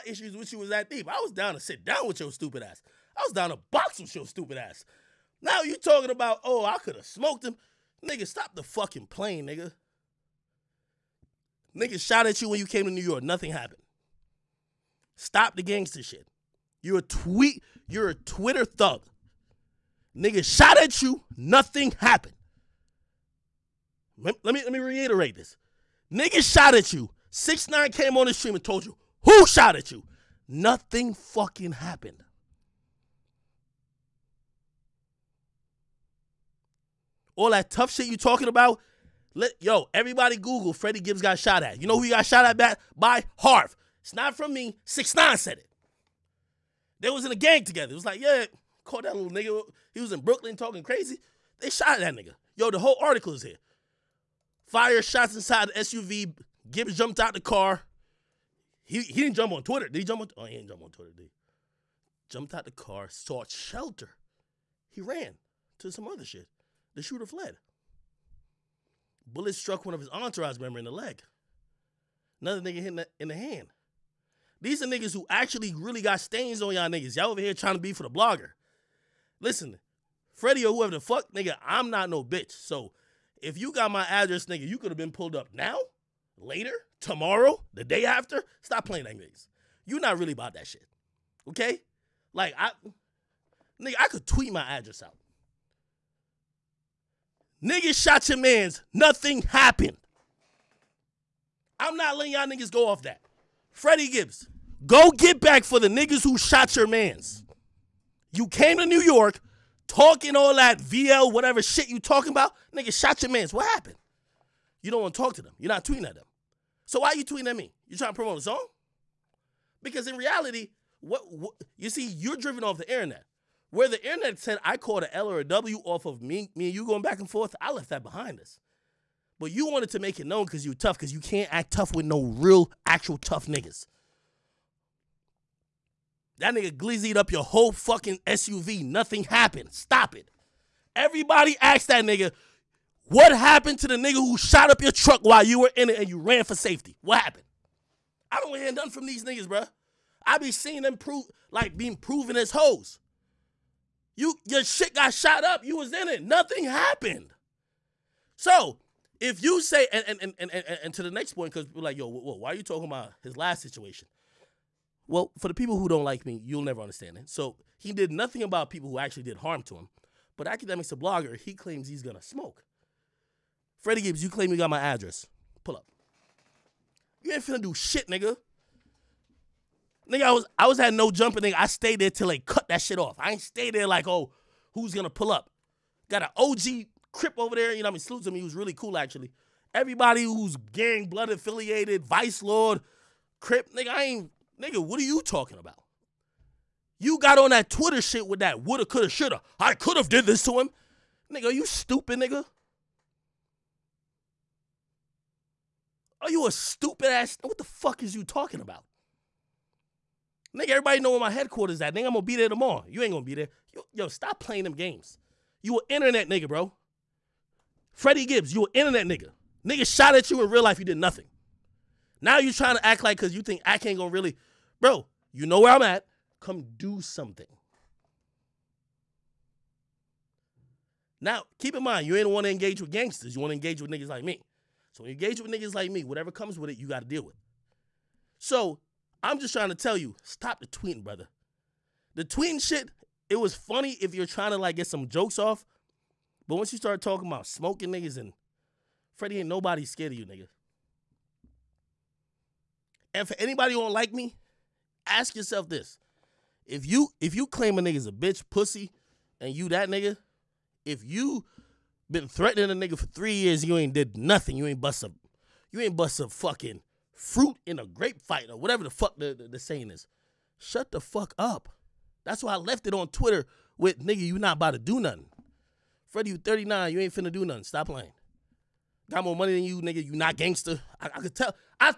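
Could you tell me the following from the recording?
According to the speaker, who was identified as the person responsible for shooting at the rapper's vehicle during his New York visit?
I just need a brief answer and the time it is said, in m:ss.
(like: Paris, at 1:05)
Harv, at 0:43.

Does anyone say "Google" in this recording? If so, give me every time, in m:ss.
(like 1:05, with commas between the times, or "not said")
0:40.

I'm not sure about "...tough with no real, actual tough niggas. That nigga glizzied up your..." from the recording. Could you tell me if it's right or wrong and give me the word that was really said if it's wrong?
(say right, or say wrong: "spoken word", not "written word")
right.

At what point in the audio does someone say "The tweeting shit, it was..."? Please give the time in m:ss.
4:02.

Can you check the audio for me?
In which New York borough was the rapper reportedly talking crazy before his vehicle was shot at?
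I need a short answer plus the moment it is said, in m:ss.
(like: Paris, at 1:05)
Brooklyn, at 0:50.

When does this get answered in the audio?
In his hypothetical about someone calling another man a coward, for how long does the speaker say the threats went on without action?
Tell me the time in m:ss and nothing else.
4:23.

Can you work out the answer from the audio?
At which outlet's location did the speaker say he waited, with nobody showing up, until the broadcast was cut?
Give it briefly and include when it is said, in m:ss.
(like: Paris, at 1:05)
No Jumper, at 3:00.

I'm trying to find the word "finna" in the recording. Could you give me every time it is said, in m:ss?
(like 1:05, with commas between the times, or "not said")
2:57, 4:37.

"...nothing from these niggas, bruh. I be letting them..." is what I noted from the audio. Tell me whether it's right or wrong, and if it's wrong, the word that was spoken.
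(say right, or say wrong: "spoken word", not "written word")
wrong: "seeing", not "letting".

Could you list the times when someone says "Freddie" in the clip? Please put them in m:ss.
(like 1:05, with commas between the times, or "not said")
0:40, 1:20, 1:43, 2:53, 3:37, 4:09, 4:36.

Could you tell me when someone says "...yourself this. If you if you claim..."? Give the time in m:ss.
4:15.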